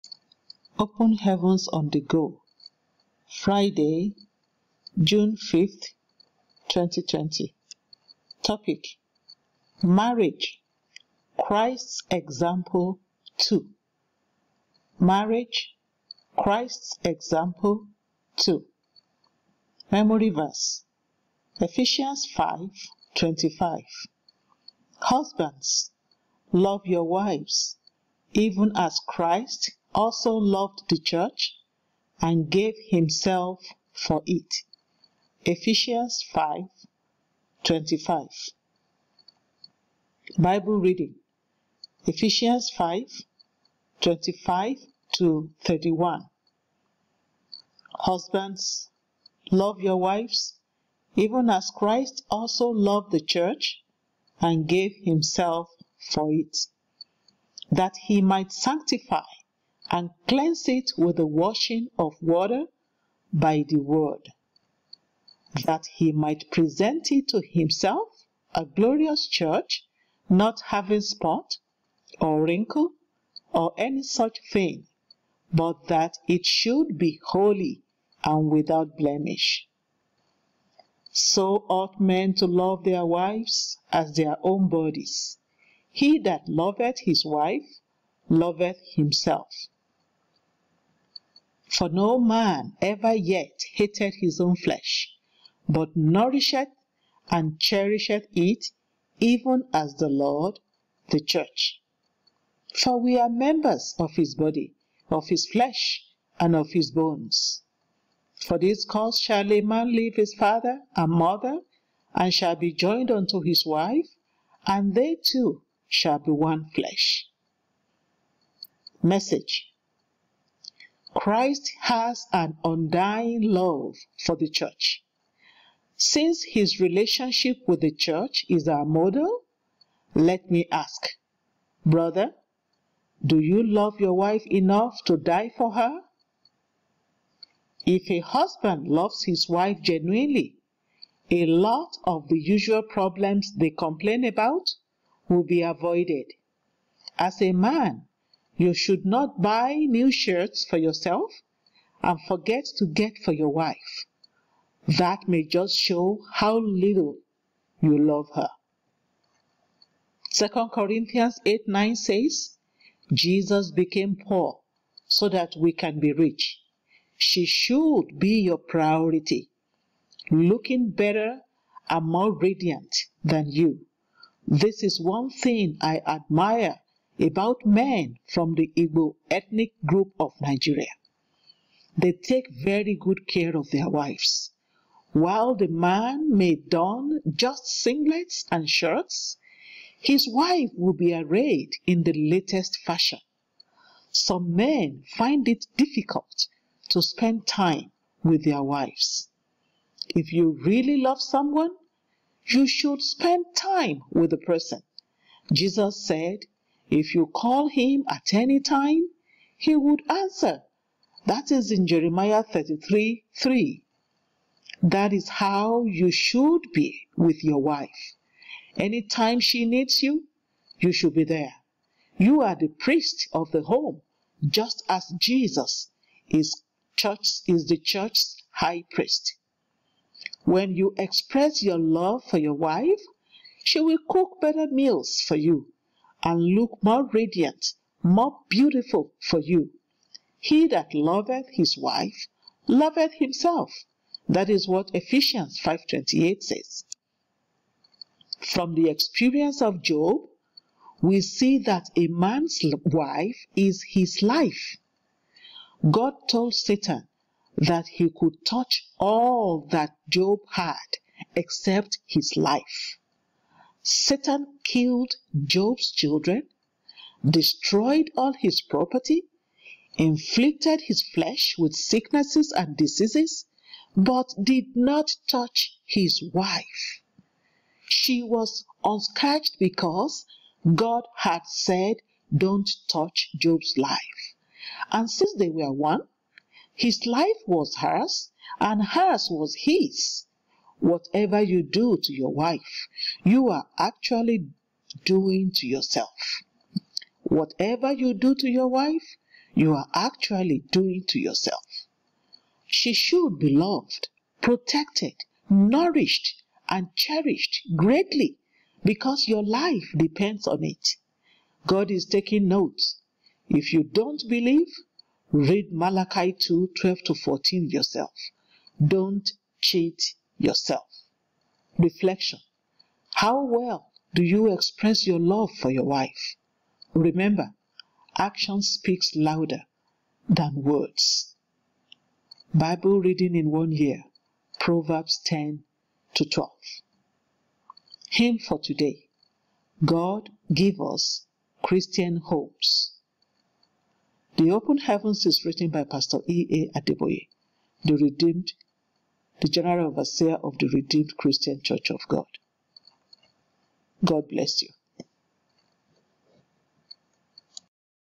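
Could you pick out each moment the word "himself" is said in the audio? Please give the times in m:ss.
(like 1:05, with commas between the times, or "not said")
0:32, 0:55, 1:07, 1:28, 4:03.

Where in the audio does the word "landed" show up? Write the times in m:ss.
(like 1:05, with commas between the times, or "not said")
not said.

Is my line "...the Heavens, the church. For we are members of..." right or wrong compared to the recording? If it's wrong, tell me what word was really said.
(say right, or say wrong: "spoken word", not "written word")
wrong: "Lord", not "Heavens".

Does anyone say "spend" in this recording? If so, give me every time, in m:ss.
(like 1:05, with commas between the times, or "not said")
3:17, 3:23.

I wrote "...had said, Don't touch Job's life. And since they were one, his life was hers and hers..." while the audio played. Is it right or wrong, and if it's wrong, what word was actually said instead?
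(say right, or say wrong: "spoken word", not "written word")
right.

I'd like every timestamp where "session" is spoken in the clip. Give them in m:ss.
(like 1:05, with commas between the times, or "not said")
not said.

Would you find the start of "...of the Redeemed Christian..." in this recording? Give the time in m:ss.
5:50.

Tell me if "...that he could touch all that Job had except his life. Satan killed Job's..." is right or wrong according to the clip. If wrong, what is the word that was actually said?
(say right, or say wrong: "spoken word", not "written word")
right.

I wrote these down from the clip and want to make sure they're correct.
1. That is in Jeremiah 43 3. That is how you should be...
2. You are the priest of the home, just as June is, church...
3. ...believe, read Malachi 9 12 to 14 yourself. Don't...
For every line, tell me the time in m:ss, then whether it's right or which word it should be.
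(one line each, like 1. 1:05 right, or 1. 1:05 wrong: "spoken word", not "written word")
1. 3:31 wrong: "33", not "43"
2. 3:42 wrong: "Jesus", not "June"
3. 5:14 wrong: "2", not "9".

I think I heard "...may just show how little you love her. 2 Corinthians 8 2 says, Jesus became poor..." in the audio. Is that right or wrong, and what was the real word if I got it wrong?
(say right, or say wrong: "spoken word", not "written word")
wrong: "9", not "2".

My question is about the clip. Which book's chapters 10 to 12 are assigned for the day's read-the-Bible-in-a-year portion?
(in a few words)
Proverbs.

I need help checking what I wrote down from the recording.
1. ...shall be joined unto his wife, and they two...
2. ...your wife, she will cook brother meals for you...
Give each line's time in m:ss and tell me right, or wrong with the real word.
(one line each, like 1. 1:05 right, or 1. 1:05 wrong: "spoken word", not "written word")
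1. 1:52 right
2. 3:52 wrong: "better", not "brother".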